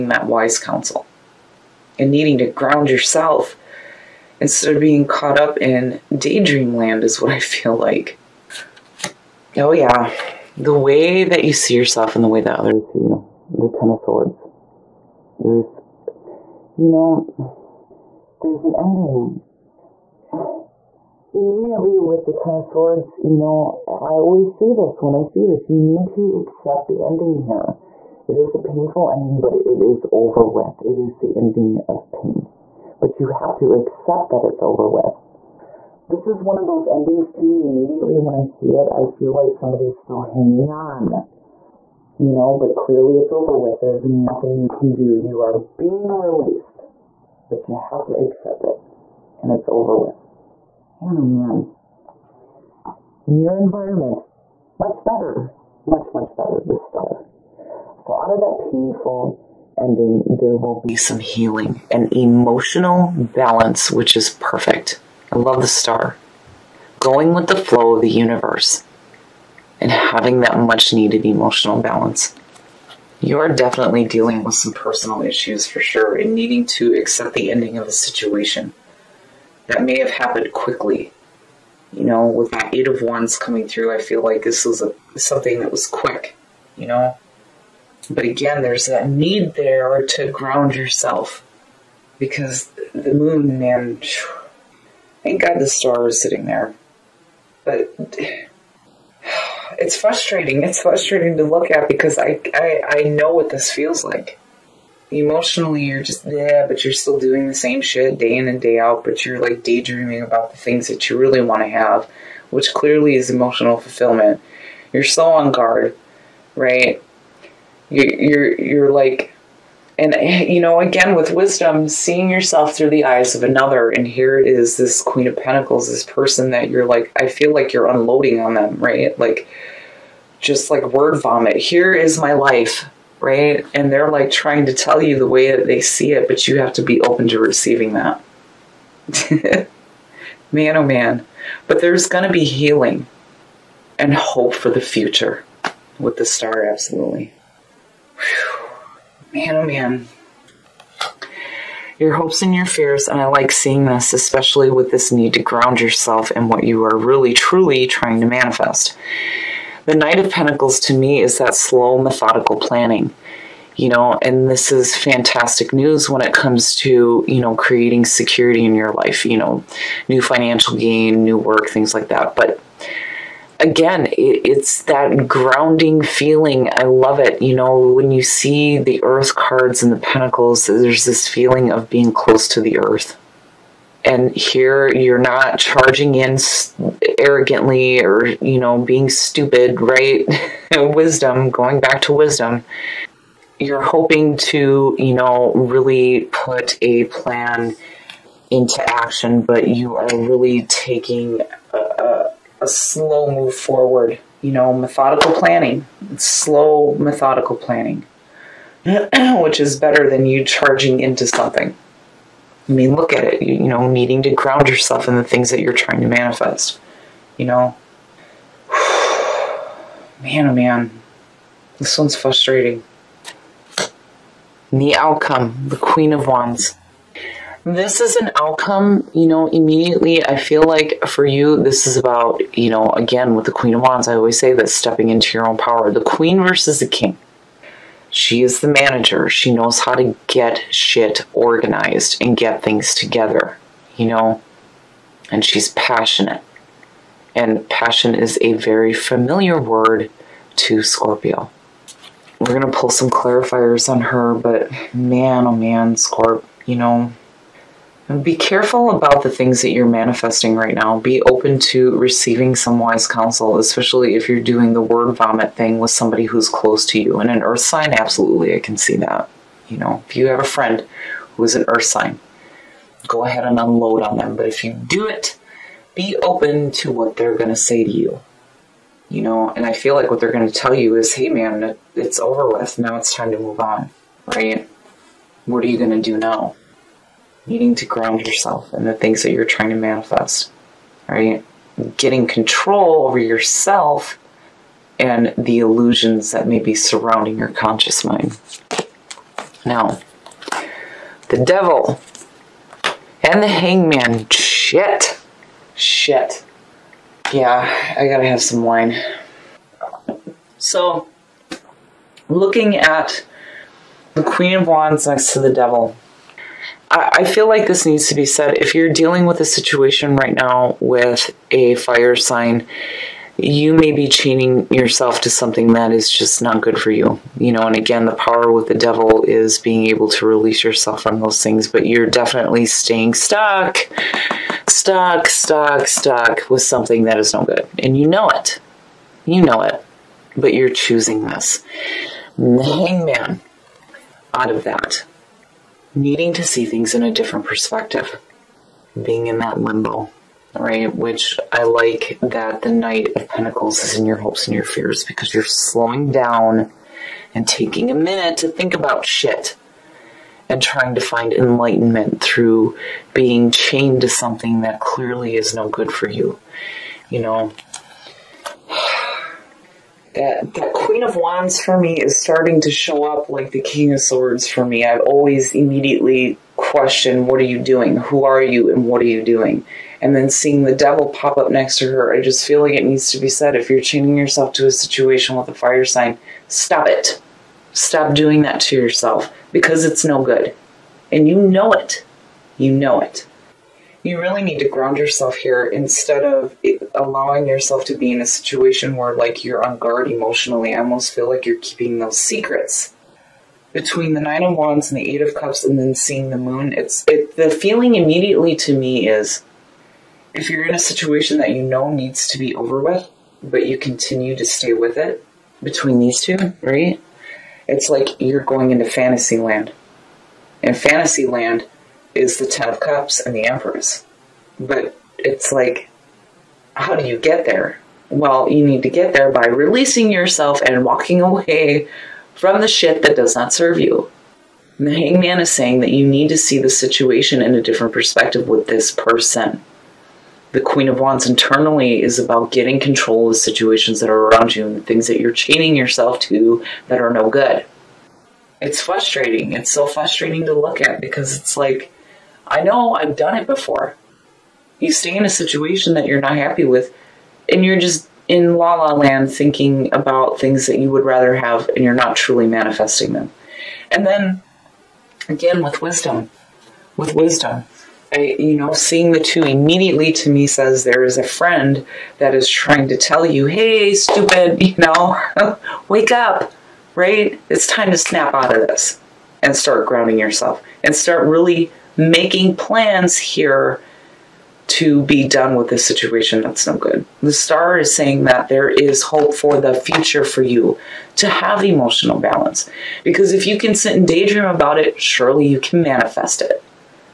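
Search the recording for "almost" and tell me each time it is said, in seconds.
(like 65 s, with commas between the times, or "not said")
400 s.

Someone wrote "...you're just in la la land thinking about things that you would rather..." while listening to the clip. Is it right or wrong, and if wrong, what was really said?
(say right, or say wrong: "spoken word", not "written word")
right.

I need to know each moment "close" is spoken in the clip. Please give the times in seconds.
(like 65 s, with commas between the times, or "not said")
182 s, 266 s.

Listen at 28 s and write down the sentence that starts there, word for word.
It is a painful ending, but it is over with.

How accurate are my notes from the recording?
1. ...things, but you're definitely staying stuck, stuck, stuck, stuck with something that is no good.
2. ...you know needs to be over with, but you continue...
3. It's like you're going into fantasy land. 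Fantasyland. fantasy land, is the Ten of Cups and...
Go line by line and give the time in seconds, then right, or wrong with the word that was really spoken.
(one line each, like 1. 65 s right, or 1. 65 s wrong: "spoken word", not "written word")
1. 331 s right
2. 411 s right
3. 417 s right.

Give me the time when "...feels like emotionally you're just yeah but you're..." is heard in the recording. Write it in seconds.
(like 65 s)
103 s.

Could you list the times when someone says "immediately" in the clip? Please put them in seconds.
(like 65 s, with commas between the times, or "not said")
21 s, 37 s, 229 s, 375 s, 407 s, 469 s.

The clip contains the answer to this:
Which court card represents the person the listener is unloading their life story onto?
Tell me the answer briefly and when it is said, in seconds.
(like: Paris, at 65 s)
Queen of Pentacles, at 125 s.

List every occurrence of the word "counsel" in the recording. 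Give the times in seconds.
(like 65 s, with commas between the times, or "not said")
0 s, 263 s.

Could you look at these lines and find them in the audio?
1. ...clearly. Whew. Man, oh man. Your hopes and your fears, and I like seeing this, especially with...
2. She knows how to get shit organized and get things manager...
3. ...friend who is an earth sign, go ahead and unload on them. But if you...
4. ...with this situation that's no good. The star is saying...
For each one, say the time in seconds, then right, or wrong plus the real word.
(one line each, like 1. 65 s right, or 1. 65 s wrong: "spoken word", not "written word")
1. 146 s wrong: "absolutely", not "clearly"
2. 239 s wrong: "together", not "manager"
3. 270 s right
4. 485 s right.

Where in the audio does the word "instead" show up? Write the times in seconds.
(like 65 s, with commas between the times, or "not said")
4 s, 395 s.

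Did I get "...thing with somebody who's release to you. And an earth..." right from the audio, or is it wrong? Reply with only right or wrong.
wrong.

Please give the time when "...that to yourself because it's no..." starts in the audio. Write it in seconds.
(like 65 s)
388 s.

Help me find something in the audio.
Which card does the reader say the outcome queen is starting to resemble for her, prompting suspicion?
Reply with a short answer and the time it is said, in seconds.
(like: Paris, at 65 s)
King of Swords, at 373 s.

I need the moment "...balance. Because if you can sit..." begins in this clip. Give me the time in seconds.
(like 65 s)
492 s.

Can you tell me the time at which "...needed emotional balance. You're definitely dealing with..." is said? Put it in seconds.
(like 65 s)
70 s.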